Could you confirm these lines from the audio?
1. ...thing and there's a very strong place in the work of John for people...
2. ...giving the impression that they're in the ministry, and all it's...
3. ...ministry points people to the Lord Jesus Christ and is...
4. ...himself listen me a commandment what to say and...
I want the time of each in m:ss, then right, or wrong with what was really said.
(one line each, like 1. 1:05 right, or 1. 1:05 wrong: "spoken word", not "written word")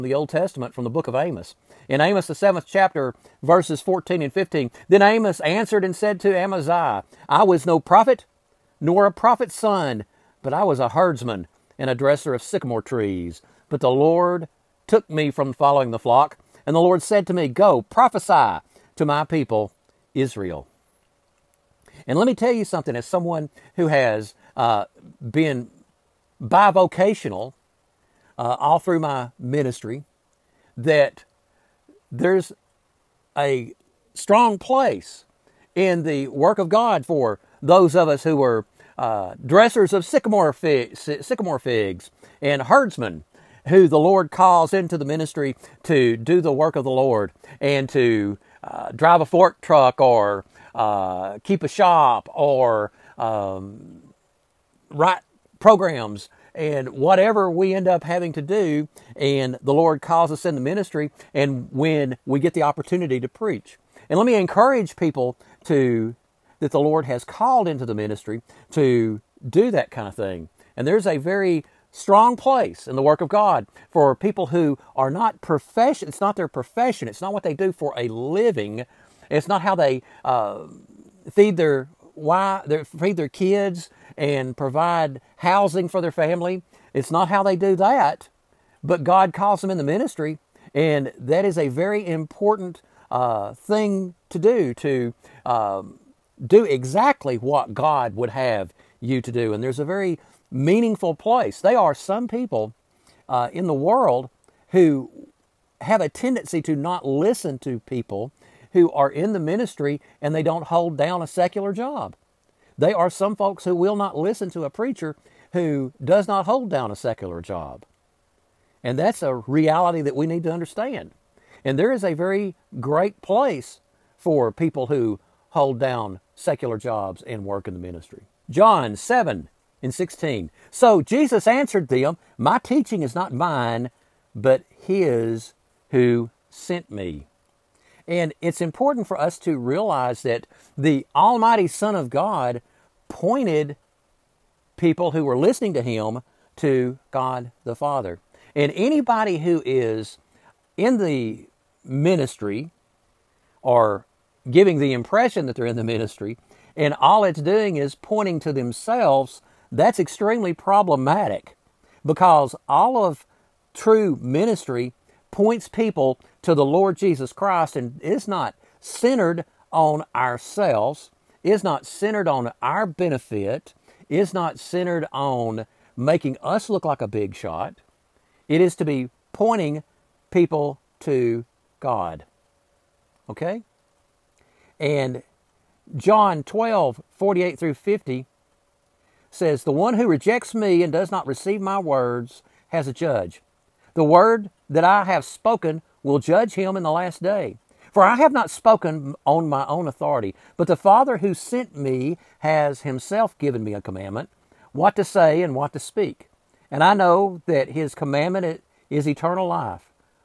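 1. 1:10 wrong: "God", not "John"
2. 2:34 right
3. 2:44 right
4. 3:22 wrong: "given", not "listen".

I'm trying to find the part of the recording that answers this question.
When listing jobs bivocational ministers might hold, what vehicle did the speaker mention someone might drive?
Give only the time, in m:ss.
0:49.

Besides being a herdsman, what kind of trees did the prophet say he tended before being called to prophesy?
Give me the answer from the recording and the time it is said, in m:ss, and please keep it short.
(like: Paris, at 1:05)
Sycamore trees, at 0:12.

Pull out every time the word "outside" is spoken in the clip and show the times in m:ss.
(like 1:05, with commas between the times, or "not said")
not said.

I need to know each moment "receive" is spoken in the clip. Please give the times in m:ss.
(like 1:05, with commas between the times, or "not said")
3:11.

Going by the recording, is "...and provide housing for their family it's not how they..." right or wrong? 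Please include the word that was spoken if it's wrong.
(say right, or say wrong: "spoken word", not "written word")
right.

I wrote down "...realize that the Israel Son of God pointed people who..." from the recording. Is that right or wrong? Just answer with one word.
wrong.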